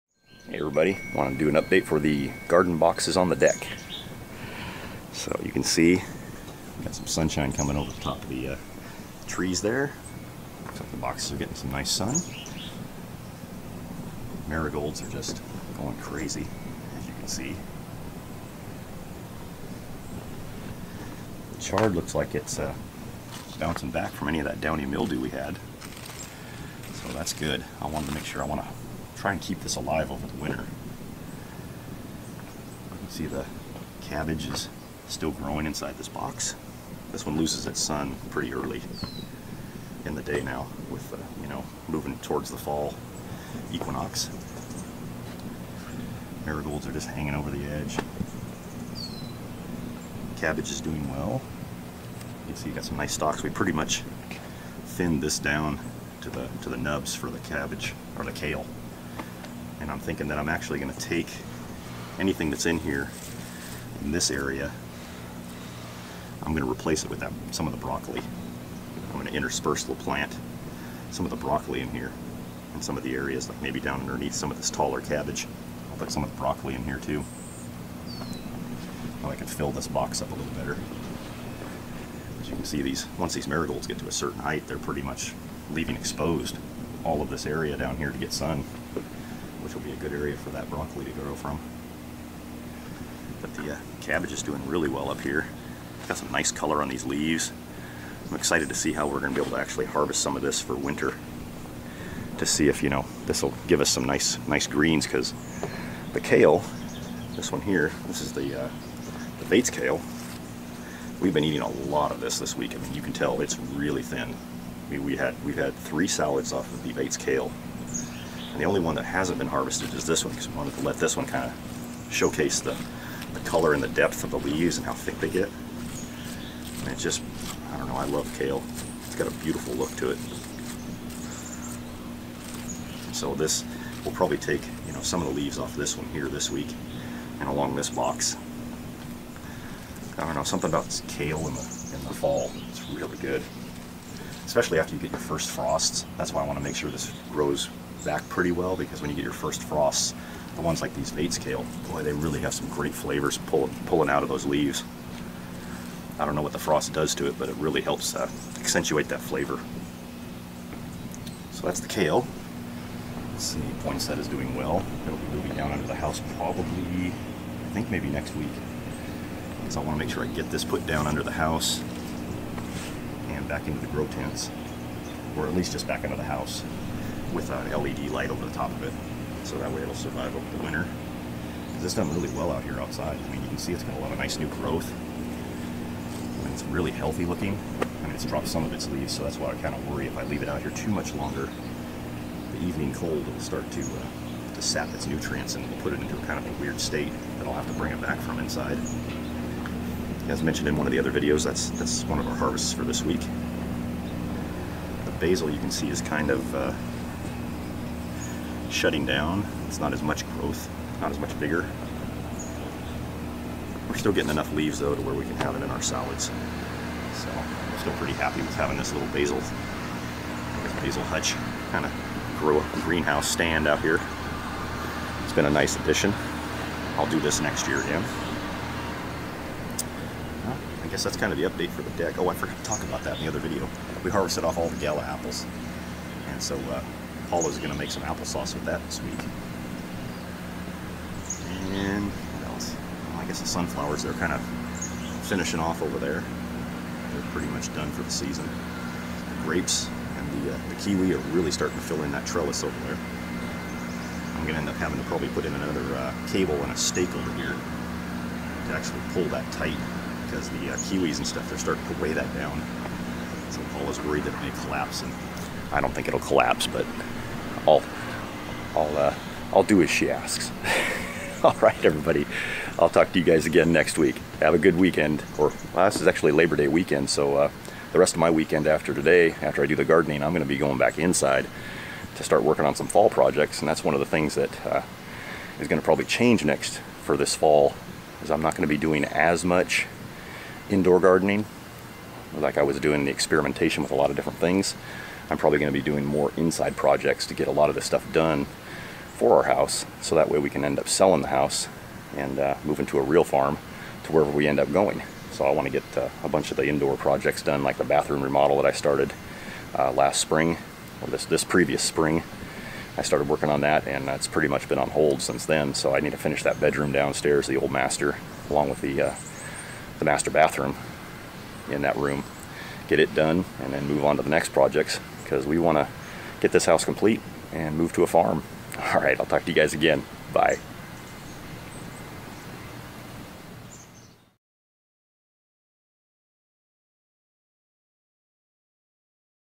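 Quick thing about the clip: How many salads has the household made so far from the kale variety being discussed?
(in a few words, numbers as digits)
3.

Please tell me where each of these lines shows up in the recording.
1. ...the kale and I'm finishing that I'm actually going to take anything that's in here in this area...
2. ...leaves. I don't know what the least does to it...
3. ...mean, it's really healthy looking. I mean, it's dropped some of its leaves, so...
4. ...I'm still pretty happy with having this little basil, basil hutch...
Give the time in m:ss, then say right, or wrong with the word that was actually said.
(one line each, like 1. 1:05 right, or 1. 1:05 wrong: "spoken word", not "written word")
1. 0:58 wrong: "thinking", not "finishing"
2. 2:34 wrong: "frost", not "least"
3. 3:06 right
4. 3:37 right.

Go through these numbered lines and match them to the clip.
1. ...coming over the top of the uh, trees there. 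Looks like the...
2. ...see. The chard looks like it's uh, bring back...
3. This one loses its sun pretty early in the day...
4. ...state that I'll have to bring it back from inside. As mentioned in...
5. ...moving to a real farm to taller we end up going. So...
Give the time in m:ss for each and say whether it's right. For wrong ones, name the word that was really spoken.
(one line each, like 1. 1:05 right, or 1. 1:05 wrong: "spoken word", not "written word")
1. 0:07 right
2. 0:17 wrong: "bouncing", not "bring"
3. 0:37 right
4. 3:16 right
5. 5:02 wrong: "wherever", not "taller".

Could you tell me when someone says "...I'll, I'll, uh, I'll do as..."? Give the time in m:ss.
4:27.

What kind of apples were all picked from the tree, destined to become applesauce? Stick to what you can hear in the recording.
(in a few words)
Gala.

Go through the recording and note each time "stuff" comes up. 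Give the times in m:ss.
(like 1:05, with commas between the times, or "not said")
4:21, 4:57.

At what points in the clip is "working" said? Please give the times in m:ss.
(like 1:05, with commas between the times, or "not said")
4:42, 5:13.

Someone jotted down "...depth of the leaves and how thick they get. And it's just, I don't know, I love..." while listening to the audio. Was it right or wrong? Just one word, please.
right.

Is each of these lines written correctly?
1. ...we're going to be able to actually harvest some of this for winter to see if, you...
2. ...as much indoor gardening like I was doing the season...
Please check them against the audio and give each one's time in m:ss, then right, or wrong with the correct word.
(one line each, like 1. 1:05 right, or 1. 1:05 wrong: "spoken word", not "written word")
1. 1:39 right
2. 4:49 wrong: "experimentation", not "season".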